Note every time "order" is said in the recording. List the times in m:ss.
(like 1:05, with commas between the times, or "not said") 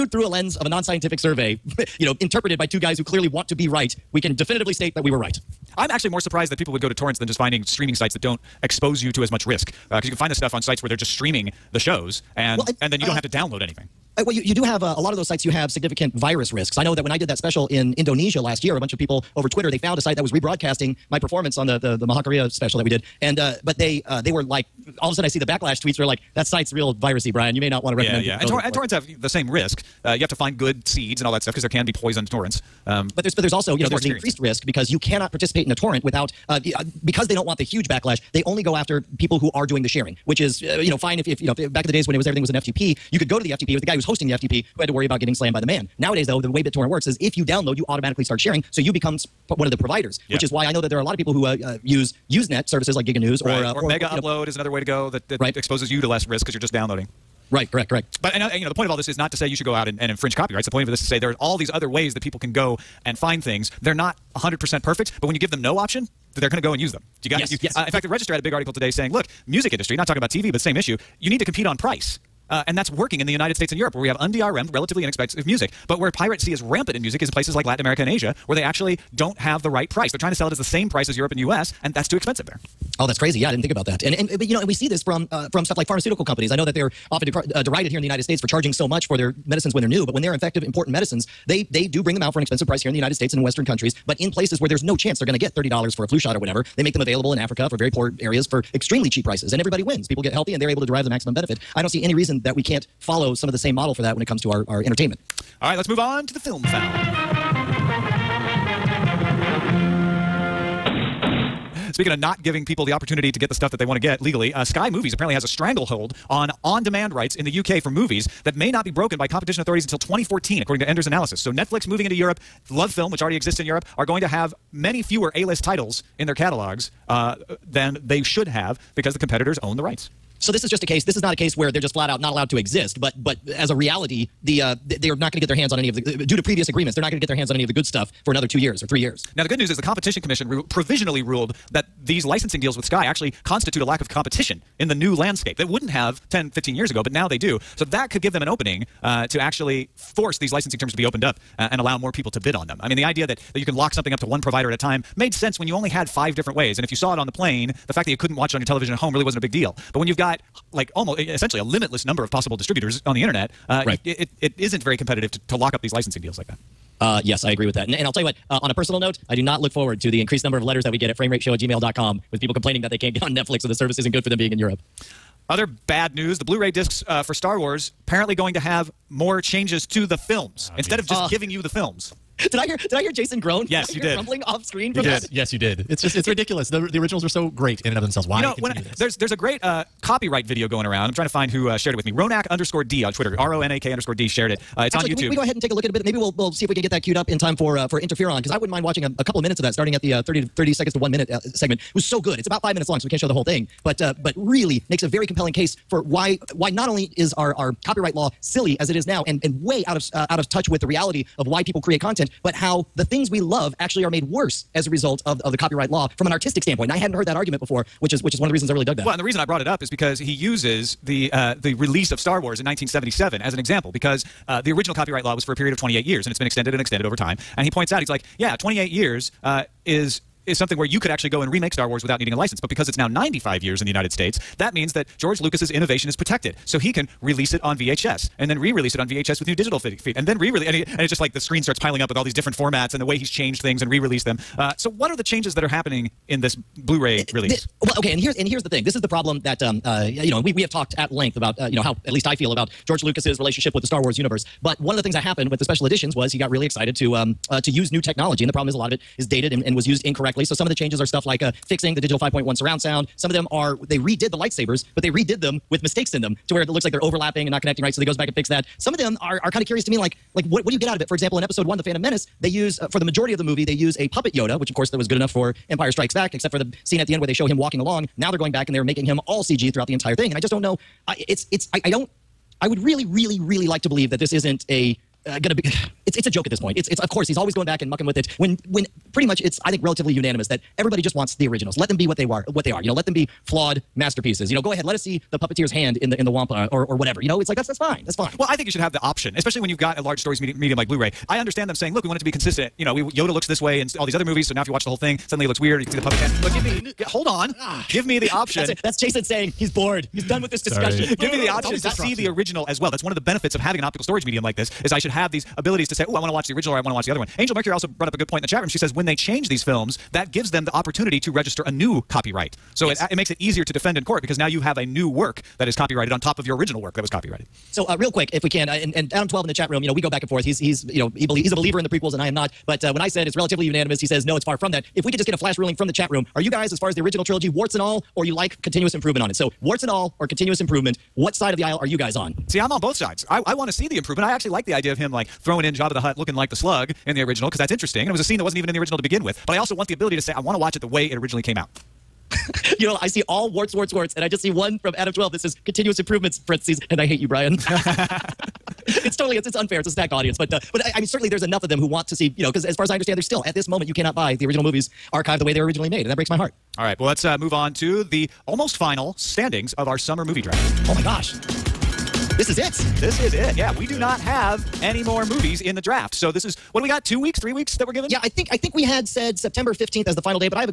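not said.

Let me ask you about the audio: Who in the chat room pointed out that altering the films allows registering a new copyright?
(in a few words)
Angel Mercury.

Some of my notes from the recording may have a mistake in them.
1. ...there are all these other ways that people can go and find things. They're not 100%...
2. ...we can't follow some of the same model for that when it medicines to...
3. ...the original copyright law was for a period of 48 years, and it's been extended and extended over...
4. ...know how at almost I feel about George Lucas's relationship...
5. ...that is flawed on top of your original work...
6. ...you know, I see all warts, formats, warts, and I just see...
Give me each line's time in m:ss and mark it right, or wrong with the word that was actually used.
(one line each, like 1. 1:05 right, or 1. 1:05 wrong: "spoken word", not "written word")
1. 1:01 right
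2. 1:42 wrong: "comes", not "medicines"
3. 3:44 wrong: "28", not "48"
4. 4:11 wrong: "least", not "almost"
5. 5:25 wrong: "copyrighted", not "flawed"
6. 5:52 wrong: "warts", not "formats".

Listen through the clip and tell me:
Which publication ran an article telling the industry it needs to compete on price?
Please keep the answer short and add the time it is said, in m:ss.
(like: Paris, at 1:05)
the Register, at 1:08.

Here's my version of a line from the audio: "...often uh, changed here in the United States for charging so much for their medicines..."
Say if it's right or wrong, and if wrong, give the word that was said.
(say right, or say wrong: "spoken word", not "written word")
wrong: "derided", not "changed".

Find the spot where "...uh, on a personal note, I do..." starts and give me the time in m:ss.
2:48.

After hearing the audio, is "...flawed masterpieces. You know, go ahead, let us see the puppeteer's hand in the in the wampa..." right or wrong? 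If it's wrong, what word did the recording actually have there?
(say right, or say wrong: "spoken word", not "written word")
right.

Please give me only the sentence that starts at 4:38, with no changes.
Now they're going back and they're making him all CG throughout the entire thing, and I just don't know.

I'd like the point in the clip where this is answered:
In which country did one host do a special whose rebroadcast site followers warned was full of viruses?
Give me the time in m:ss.
0:17.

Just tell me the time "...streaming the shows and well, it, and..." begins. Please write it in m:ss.
0:11.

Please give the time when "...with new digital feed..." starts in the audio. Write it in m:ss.
3:59.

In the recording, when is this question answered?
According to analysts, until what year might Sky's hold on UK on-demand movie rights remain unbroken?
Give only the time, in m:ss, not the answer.
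1:59.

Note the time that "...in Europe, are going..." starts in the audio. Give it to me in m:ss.
2:03.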